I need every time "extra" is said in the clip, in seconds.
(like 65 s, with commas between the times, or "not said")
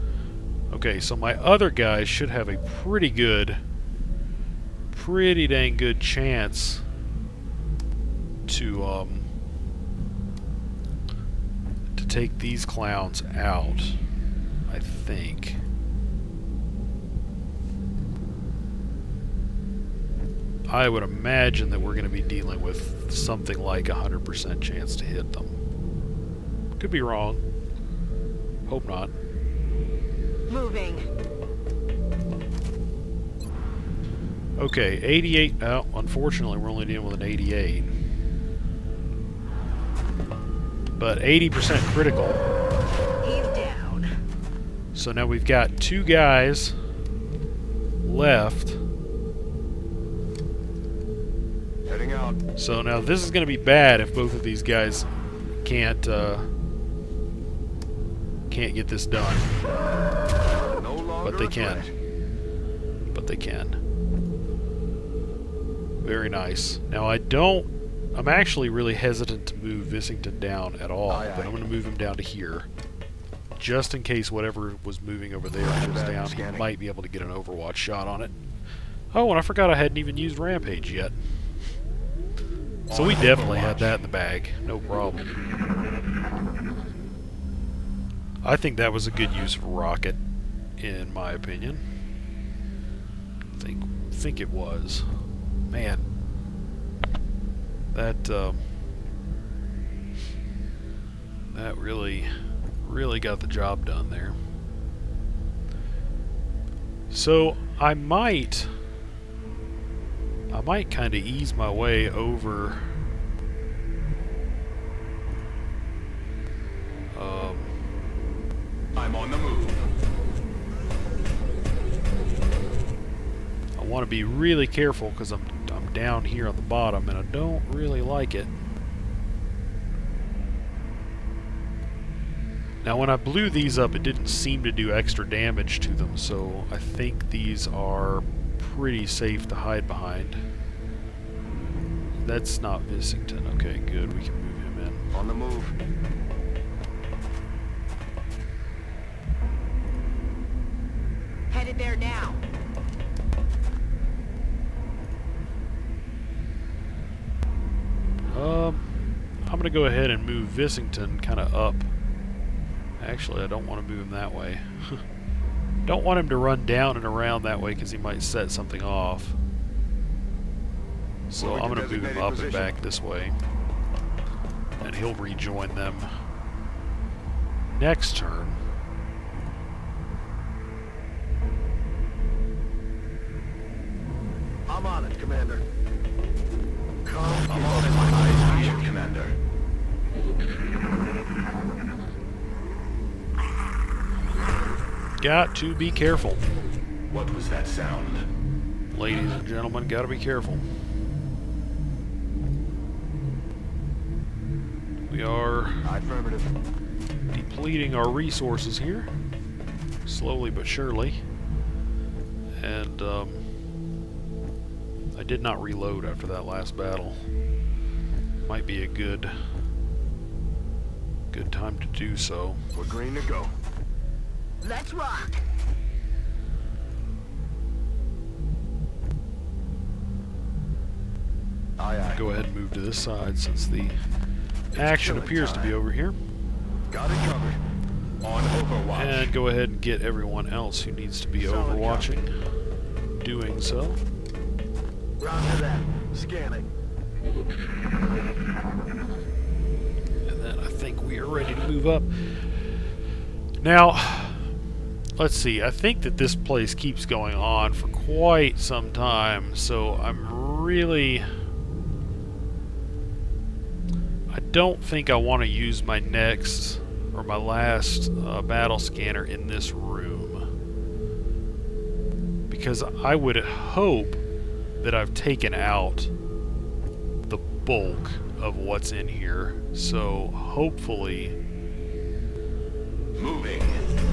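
134 s.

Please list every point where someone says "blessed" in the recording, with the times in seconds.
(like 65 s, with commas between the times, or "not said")
not said.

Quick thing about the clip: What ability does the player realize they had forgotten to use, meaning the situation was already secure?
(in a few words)
Rampage.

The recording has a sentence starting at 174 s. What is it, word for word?
And he'll rejoin them next turn.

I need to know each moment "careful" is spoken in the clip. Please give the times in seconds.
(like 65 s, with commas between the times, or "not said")
124 s, 195 s, 200 s.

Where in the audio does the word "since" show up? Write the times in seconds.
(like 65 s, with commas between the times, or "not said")
233 s.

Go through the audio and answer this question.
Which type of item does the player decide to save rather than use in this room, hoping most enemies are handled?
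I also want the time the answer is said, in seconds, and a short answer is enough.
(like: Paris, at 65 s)
battle scanner, at 268 s.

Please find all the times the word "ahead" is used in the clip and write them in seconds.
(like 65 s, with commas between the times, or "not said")
159 s, 232 s, 239 s.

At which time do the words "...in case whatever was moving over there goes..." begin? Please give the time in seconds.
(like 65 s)
73 s.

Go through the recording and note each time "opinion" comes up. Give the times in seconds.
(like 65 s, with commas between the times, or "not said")
91 s.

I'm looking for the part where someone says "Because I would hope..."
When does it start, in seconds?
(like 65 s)
272 s.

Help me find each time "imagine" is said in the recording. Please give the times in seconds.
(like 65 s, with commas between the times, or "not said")
21 s.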